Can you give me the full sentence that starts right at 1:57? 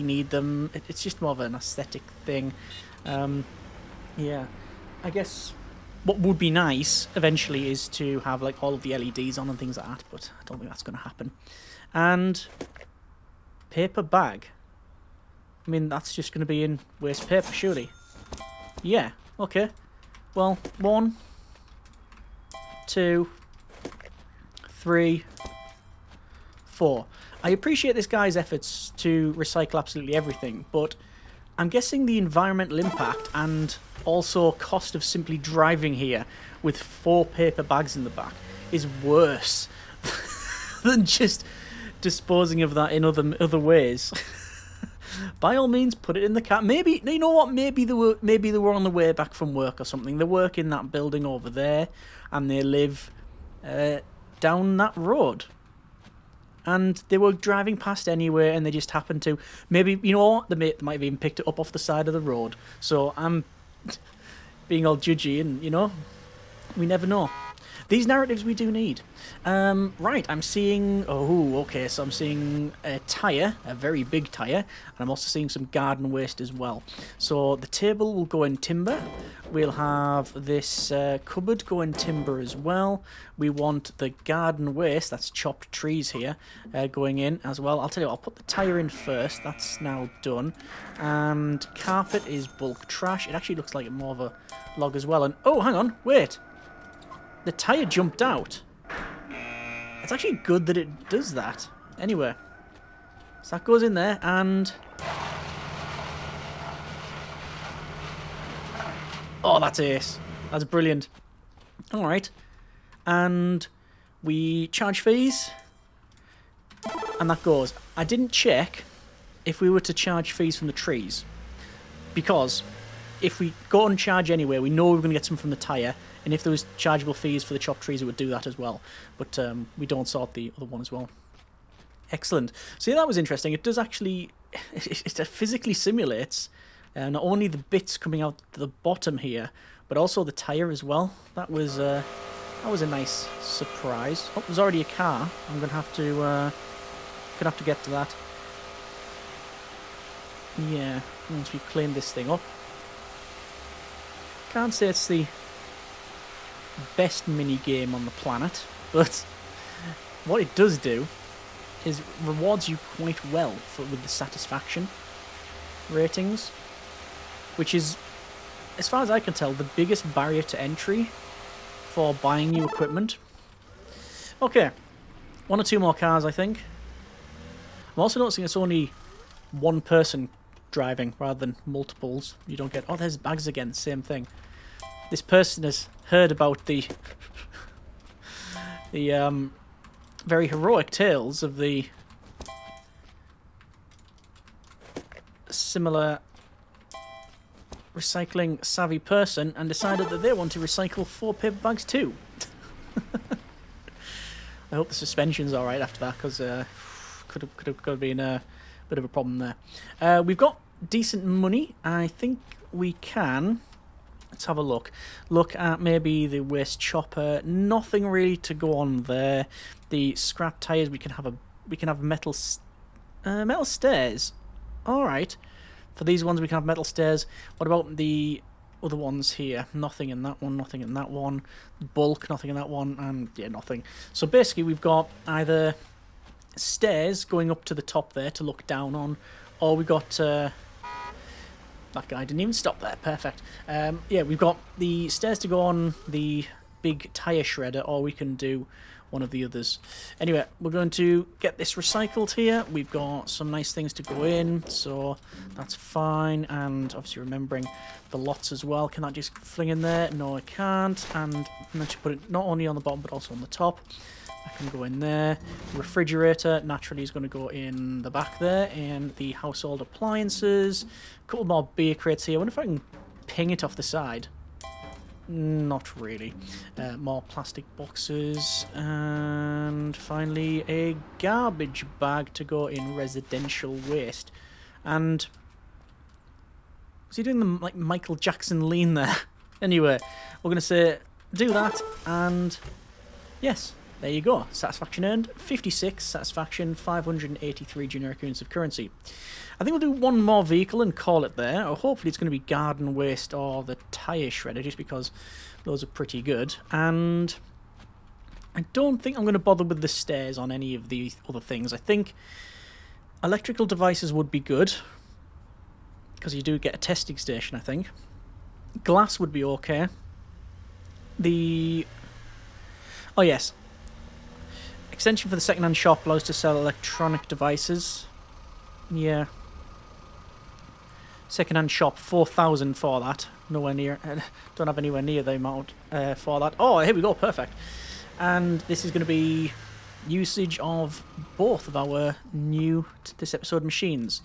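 I didn't check if we were to charge fees from the trees.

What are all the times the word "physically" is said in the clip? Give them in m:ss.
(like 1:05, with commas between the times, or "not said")
2:15.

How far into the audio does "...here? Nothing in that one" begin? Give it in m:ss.
3:49.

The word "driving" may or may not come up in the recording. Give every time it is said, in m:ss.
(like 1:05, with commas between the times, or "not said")
0:35, 0:57, 3:00.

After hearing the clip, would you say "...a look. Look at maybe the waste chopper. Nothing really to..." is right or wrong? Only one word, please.
right.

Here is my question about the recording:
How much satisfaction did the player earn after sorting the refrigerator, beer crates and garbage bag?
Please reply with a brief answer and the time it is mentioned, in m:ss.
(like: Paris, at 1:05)
56, at 4:55.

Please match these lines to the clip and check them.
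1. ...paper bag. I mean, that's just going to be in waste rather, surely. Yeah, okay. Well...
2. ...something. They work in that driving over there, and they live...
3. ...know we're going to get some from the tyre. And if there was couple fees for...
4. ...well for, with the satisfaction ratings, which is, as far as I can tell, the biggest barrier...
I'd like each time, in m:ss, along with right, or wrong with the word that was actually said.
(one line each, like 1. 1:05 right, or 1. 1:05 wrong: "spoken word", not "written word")
1. 0:13 wrong: "paper", not "rather"
2. 0:49 wrong: "building", not "driving"
3. 2:04 wrong: "chargeable", not "couple"
4. 2:43 right.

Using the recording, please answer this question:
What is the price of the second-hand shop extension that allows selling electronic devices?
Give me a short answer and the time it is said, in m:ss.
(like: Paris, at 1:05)
4,000, at 5:31.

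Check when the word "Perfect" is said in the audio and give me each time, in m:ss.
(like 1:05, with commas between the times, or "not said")
4:03, 5:37.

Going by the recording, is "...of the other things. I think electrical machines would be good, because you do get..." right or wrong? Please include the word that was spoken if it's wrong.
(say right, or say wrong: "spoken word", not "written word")
wrong: "devices", not "machines".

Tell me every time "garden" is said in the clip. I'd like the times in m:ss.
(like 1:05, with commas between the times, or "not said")
1:15, 1:24, 5:02.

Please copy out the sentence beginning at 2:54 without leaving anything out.
Okay, one or two more cars, I think.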